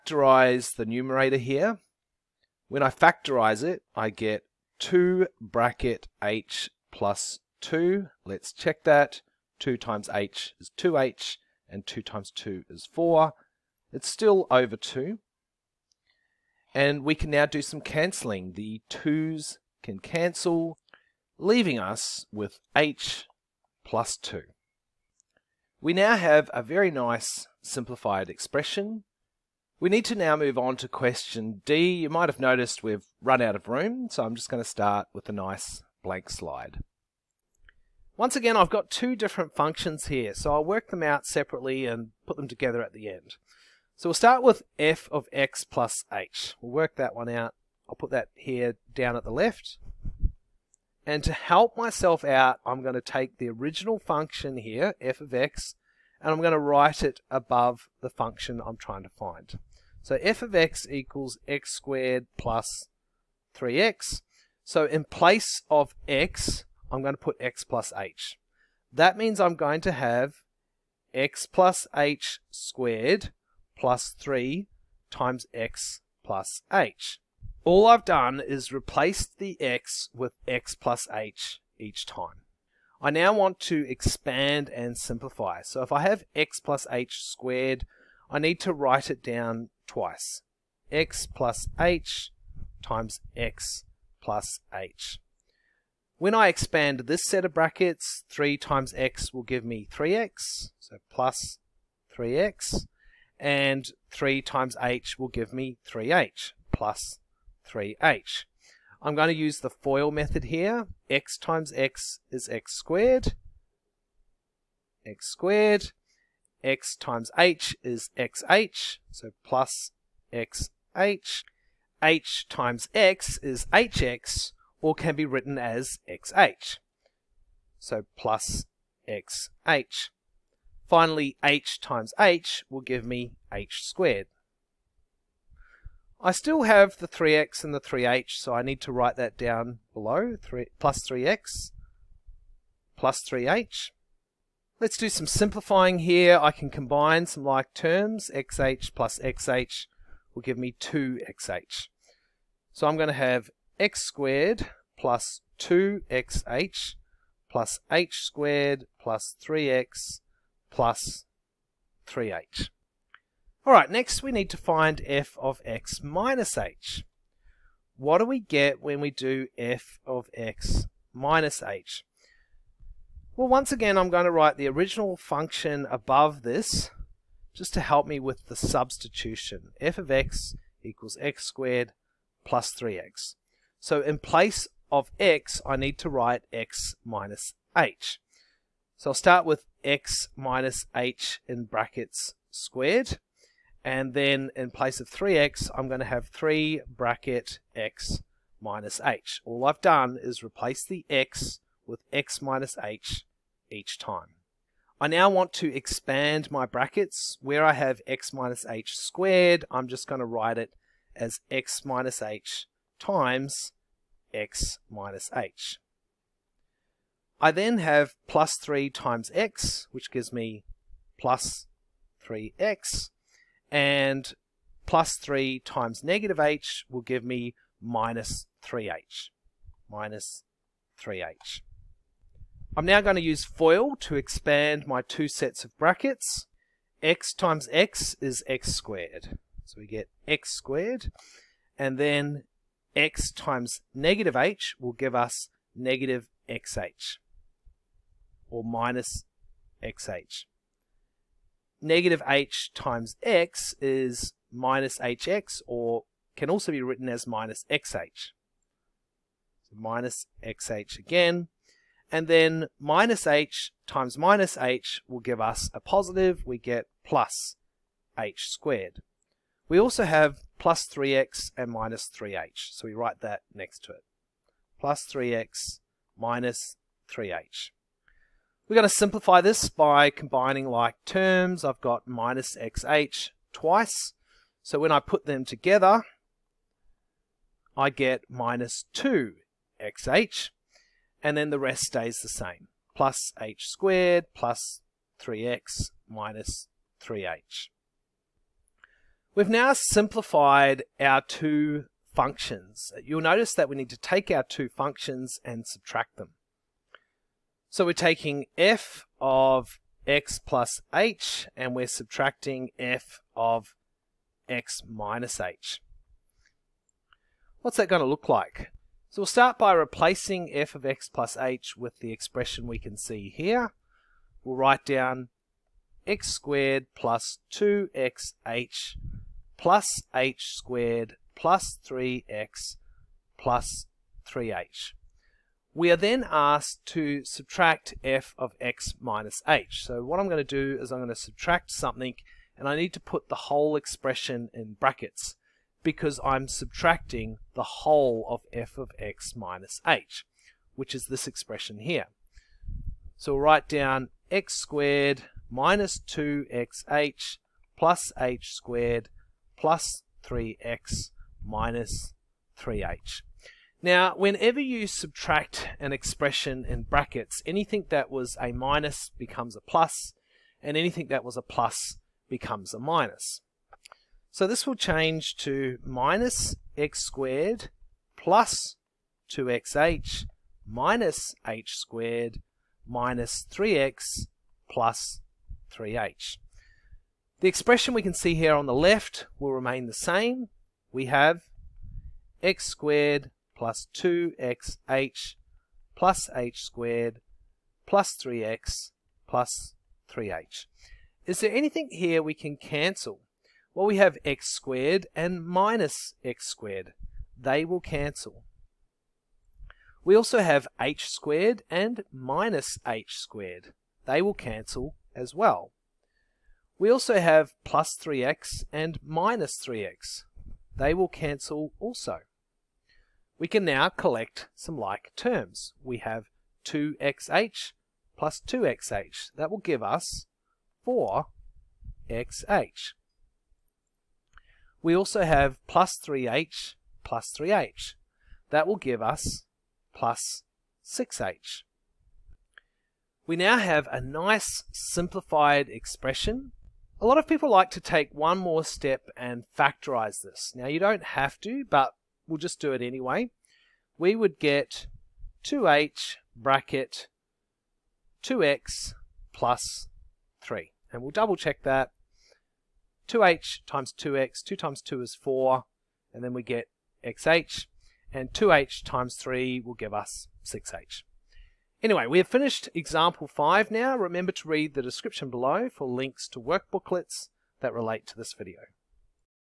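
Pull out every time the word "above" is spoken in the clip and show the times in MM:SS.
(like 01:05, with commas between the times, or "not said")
00:57, 02:55.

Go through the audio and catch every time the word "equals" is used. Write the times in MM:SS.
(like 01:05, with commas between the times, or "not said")
01:00, 03:00.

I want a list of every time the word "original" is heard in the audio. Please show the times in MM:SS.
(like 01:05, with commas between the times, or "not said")
00:53, 02:54.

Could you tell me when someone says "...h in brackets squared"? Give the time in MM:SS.
03:10.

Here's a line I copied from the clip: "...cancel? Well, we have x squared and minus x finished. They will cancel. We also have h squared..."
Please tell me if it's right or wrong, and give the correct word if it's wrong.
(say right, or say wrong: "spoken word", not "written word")
wrong: "squared", not "finished".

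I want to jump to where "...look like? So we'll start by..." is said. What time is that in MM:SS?
05:18.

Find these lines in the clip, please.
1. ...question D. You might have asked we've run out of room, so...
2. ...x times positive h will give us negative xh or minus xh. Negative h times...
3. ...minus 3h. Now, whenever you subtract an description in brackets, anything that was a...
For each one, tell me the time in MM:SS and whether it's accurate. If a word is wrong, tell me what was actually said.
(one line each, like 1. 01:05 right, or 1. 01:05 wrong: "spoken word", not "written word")
1. 00:30 wrong: "noticed", not "asked"
2. 04:02 wrong: "negative", not "positive"
3. 06:01 wrong: "expression", not "description".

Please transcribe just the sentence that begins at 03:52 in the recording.
I'm now going to use FOIL to expand my two sets of brackets.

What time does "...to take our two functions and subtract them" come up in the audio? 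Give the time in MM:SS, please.
05:03.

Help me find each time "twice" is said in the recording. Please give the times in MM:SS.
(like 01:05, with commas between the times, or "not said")
01:29, 04:43.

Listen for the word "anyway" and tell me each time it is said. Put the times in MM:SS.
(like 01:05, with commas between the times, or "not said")
07:32, 07:51.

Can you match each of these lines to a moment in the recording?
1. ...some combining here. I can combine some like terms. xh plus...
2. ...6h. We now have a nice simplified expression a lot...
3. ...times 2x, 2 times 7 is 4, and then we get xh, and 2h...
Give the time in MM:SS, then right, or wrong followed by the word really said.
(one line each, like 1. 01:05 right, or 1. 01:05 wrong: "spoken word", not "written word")
1. 02:25 wrong: "simplifying", not "combining"
2. 07:20 right
3. 07:43 wrong: "2", not "7".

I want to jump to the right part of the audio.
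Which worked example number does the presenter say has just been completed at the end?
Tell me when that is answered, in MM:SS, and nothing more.
07:52.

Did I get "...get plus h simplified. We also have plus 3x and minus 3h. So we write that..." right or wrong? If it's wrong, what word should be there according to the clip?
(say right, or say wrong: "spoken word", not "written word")
wrong: "squared", not "simplified".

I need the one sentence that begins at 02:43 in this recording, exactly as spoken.
Alright, next we need to find f of x minus h.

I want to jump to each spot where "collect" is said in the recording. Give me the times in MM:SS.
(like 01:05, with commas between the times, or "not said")
07:03.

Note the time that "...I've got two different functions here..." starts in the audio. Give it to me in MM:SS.
00:38.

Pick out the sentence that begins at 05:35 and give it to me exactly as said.
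We are then asked to subtract f of x minus h.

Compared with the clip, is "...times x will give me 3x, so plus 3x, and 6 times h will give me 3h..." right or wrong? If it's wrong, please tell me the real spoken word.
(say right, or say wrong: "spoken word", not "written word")
wrong: "3", not "6".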